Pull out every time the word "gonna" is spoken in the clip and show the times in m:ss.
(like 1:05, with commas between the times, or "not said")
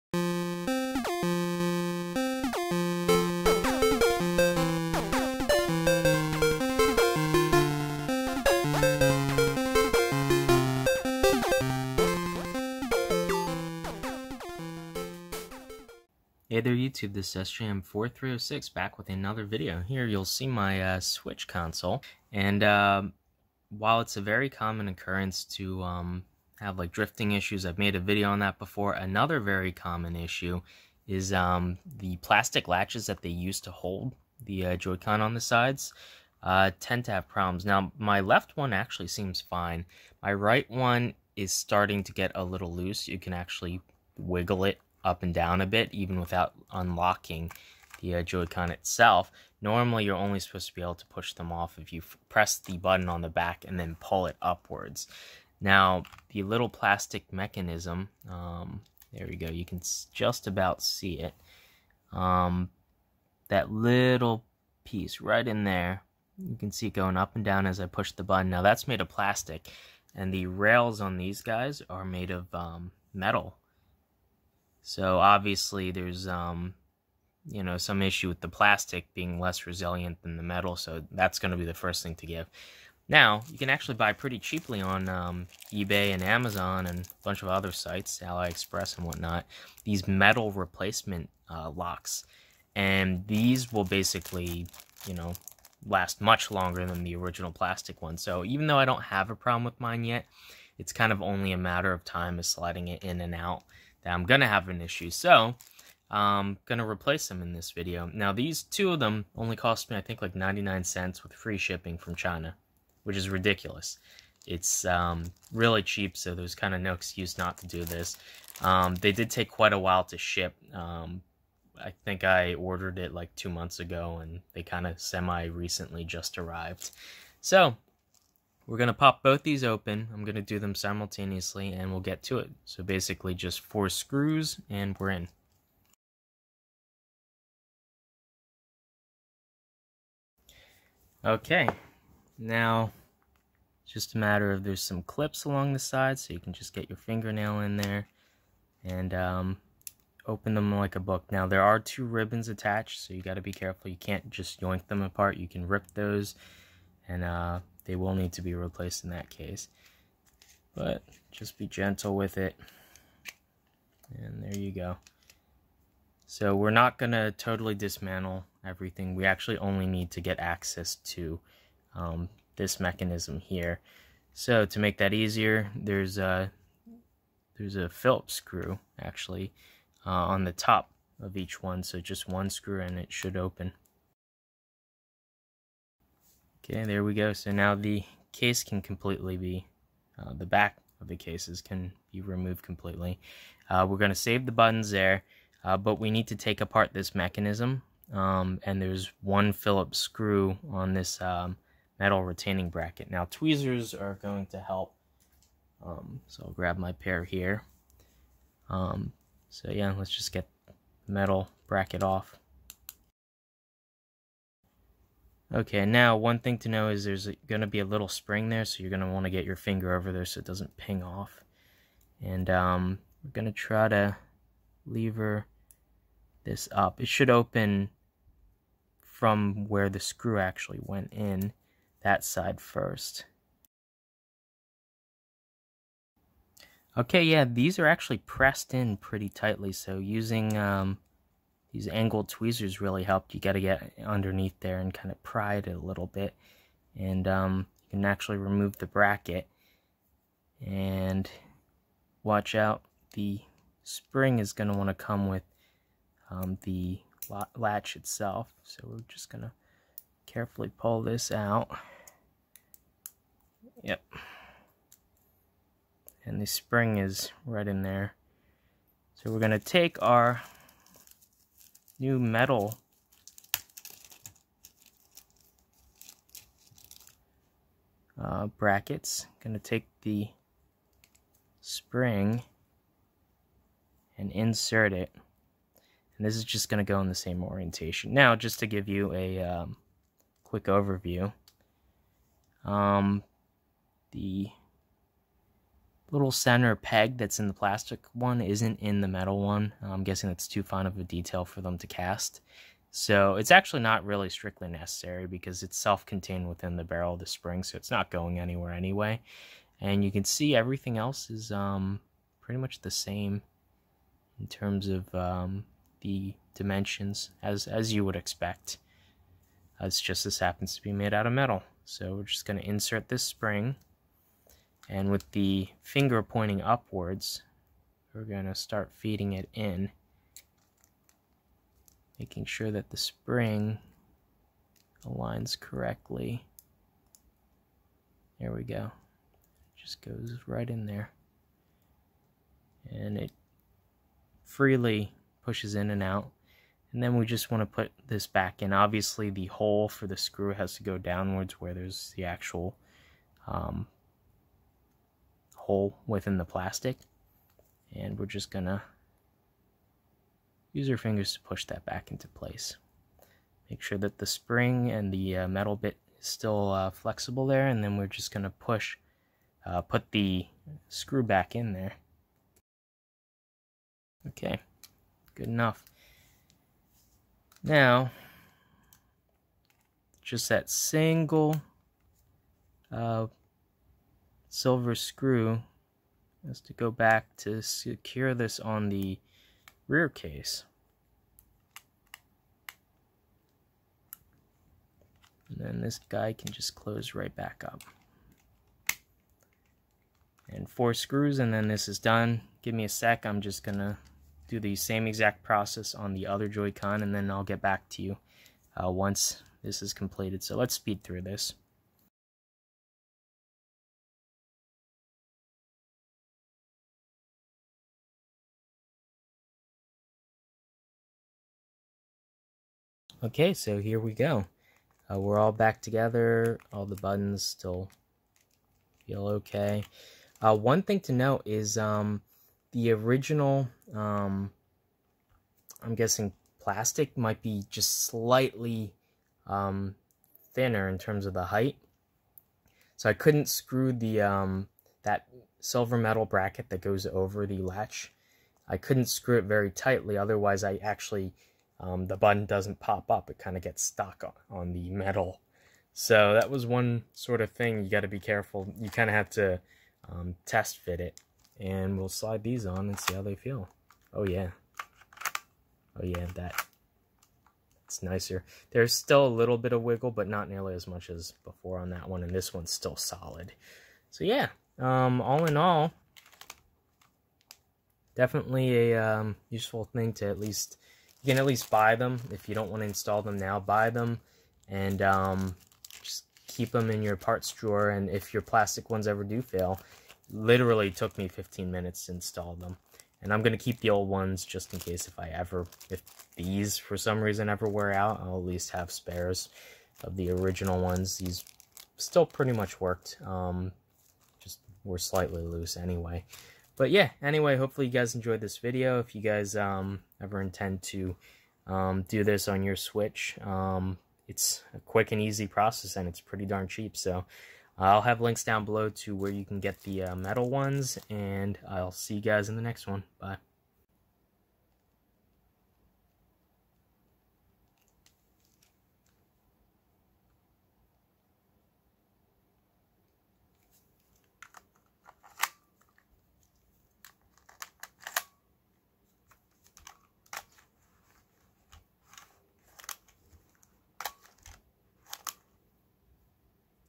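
4:39, 4:46, 5:58, 6:08, 6:43.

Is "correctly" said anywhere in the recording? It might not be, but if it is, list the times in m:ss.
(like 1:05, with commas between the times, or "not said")
5:35.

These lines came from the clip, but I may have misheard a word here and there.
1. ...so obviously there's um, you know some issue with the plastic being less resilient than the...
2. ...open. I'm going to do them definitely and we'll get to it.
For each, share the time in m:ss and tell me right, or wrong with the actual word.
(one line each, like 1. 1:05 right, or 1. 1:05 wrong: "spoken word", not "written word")
1. 1:14 right
2. 2:09 wrong: "simultaneously", not "definitely".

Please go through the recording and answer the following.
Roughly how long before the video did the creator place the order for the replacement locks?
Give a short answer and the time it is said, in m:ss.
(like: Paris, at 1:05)
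Two months, at 2:03.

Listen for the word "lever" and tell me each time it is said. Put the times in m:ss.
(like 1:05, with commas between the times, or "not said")
3:44.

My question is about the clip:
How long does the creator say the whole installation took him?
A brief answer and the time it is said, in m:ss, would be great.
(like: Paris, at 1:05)
15 minutes, at 8:11.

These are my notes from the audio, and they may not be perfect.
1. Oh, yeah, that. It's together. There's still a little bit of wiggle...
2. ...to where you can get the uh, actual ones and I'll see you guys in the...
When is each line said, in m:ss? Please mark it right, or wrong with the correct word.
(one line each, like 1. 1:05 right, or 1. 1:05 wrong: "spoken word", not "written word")
1. 7:45 wrong: "nicer", not "together"
2. 8:38 wrong: "metal", not "actual".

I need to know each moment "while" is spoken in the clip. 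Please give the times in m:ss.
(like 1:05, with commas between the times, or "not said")
0:23, 1:59.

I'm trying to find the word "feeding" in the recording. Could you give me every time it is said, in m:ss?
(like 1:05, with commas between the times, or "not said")
5:28.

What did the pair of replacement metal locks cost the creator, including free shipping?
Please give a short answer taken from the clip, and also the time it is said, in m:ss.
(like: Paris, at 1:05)
99 cents, at 1:50.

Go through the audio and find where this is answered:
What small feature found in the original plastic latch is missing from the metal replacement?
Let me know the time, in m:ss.
4:56.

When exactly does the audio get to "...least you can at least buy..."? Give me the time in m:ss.
8:00.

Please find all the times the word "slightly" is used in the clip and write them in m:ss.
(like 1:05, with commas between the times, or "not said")
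7:18, 8:24.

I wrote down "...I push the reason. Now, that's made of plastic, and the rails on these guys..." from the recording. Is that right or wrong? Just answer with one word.
wrong.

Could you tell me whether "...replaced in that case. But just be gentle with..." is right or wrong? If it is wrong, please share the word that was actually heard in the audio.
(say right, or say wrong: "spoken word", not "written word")
right.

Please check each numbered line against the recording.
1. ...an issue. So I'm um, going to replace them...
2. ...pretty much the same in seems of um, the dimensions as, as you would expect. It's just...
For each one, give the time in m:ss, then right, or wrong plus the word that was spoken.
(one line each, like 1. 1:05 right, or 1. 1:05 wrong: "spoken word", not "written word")
1. 1:44 right
2. 5:12 wrong: "terms", not "seems".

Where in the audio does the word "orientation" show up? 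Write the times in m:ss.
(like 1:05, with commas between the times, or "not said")
4:47.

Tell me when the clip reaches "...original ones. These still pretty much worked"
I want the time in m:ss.
8:20.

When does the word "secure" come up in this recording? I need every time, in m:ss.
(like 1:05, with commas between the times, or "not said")
6:27.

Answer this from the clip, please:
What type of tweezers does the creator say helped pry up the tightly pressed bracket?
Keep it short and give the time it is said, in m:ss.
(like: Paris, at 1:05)
Angled tweezers, at 4:01.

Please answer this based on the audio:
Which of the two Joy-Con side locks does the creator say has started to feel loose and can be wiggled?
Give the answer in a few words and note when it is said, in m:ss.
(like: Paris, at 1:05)
Right one, at 0:40.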